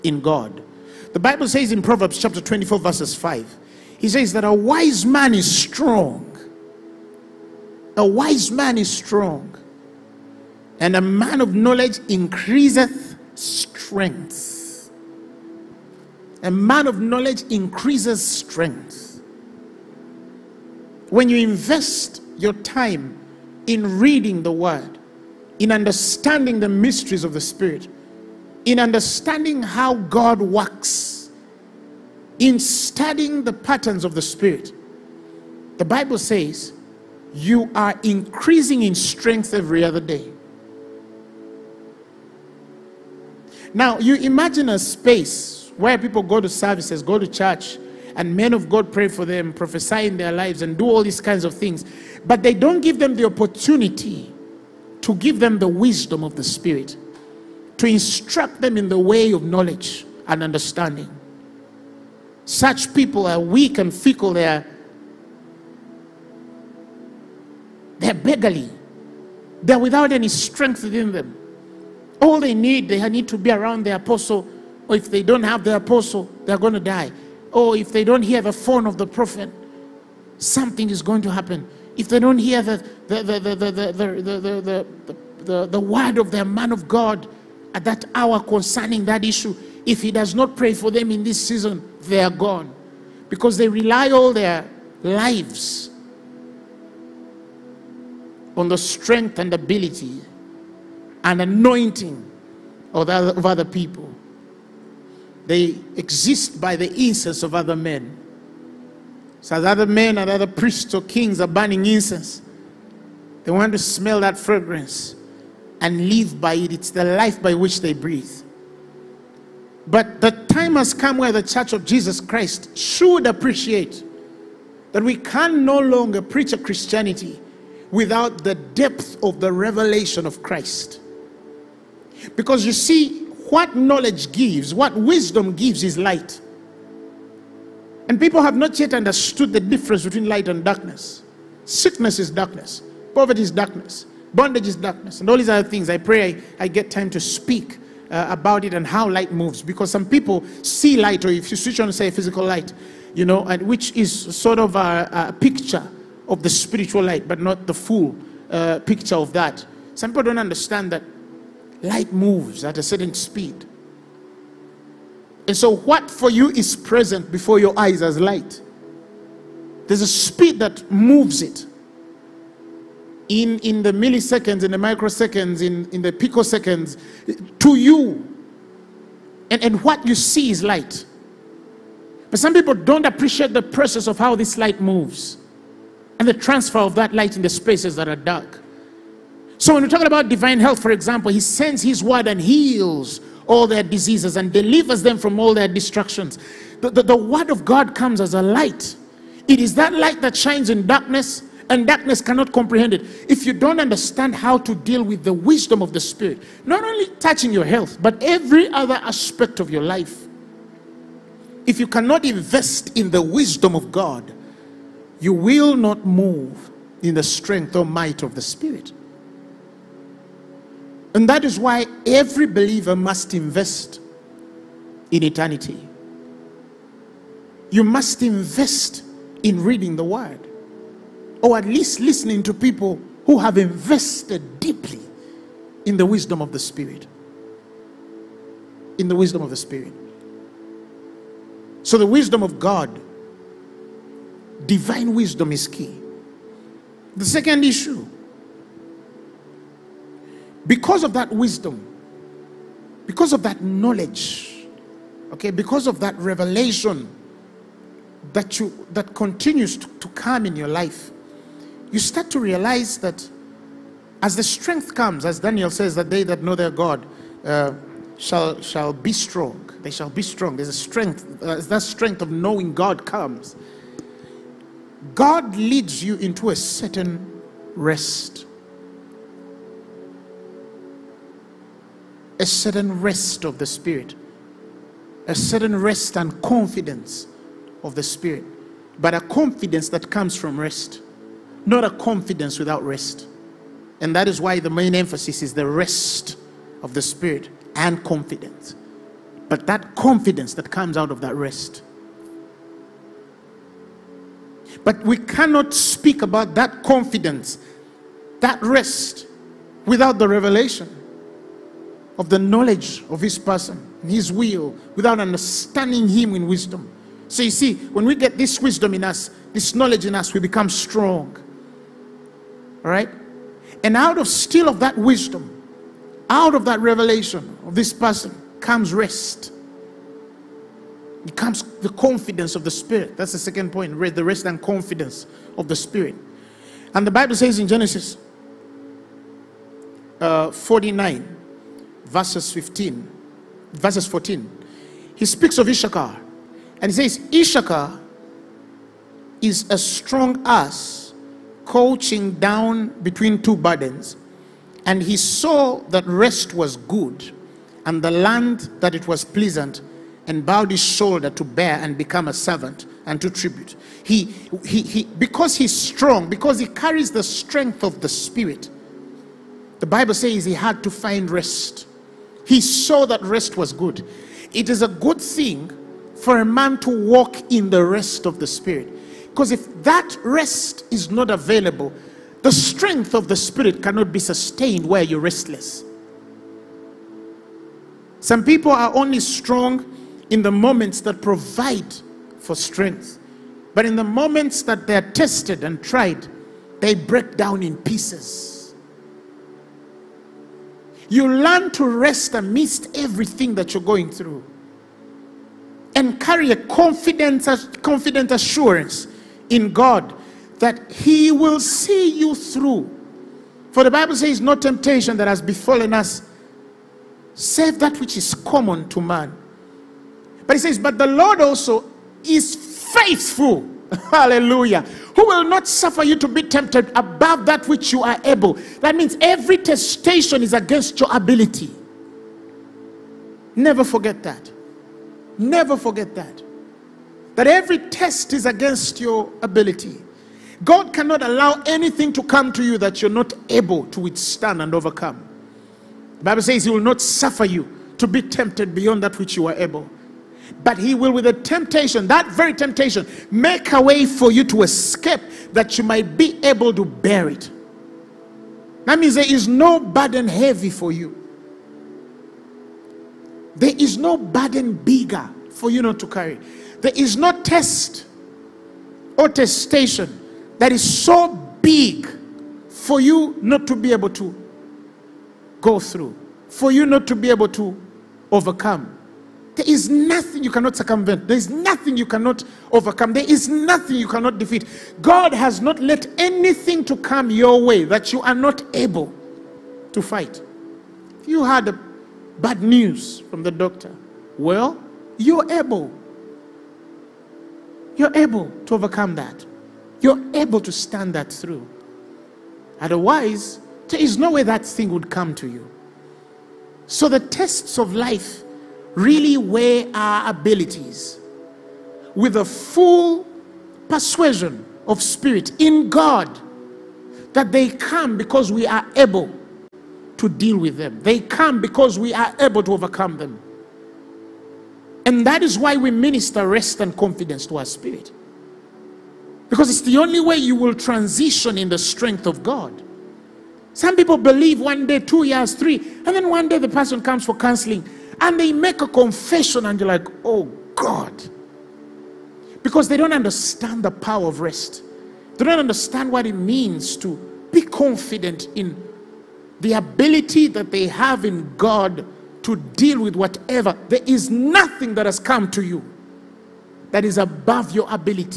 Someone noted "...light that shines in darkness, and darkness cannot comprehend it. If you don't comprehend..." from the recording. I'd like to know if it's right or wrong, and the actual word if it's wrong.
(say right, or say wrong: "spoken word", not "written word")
wrong: "understand", not "comprehend".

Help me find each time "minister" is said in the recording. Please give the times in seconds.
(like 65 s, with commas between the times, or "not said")
525 s.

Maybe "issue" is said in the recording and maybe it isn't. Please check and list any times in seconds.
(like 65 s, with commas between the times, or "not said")
89 s, 247 s.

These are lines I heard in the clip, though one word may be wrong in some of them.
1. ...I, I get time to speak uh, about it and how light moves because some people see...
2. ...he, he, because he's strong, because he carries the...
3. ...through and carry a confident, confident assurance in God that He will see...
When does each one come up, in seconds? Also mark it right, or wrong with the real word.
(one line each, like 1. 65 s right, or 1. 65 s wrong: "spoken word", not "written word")
1. 146 s right
2. 364 s right
3. 404 s right.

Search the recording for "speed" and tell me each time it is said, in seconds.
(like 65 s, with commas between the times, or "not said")
163 s, 170 s.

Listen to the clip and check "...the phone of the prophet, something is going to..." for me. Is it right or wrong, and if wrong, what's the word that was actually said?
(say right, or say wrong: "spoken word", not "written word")
right.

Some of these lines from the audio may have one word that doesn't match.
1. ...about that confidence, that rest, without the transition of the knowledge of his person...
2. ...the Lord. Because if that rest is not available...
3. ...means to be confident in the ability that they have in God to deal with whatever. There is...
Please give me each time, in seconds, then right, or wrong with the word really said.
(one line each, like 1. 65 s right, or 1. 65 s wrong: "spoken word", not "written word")
1. 306 s wrong: "revelation", not "transition"
2. 378 s wrong: "Spirit", not "Lord"
3. 546 s right.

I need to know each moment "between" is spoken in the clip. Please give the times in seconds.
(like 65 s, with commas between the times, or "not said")
140 s, 353 s.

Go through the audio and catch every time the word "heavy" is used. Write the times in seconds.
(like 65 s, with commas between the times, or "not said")
460 s.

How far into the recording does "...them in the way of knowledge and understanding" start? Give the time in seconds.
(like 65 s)
58 s.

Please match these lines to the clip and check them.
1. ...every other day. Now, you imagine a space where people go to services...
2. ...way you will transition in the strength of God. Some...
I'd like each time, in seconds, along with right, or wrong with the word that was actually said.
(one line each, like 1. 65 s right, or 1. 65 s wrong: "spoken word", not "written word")
1. 39 s right
2. 530 s right.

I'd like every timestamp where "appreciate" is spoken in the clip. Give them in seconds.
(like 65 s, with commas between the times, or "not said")
123 s, 183 s.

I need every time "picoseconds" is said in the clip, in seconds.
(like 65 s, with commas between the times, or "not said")
176 s.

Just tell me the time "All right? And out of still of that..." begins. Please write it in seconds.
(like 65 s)
322 s.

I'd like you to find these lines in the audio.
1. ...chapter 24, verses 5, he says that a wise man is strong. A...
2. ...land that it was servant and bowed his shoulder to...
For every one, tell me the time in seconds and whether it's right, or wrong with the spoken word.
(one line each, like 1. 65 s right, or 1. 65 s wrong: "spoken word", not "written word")
1. 2 s right
2. 358 s wrong: "pleasant", not "servant".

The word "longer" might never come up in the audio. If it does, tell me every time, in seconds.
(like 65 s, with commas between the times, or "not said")
125 s.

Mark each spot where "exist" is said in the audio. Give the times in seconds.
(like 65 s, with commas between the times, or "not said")
105 s.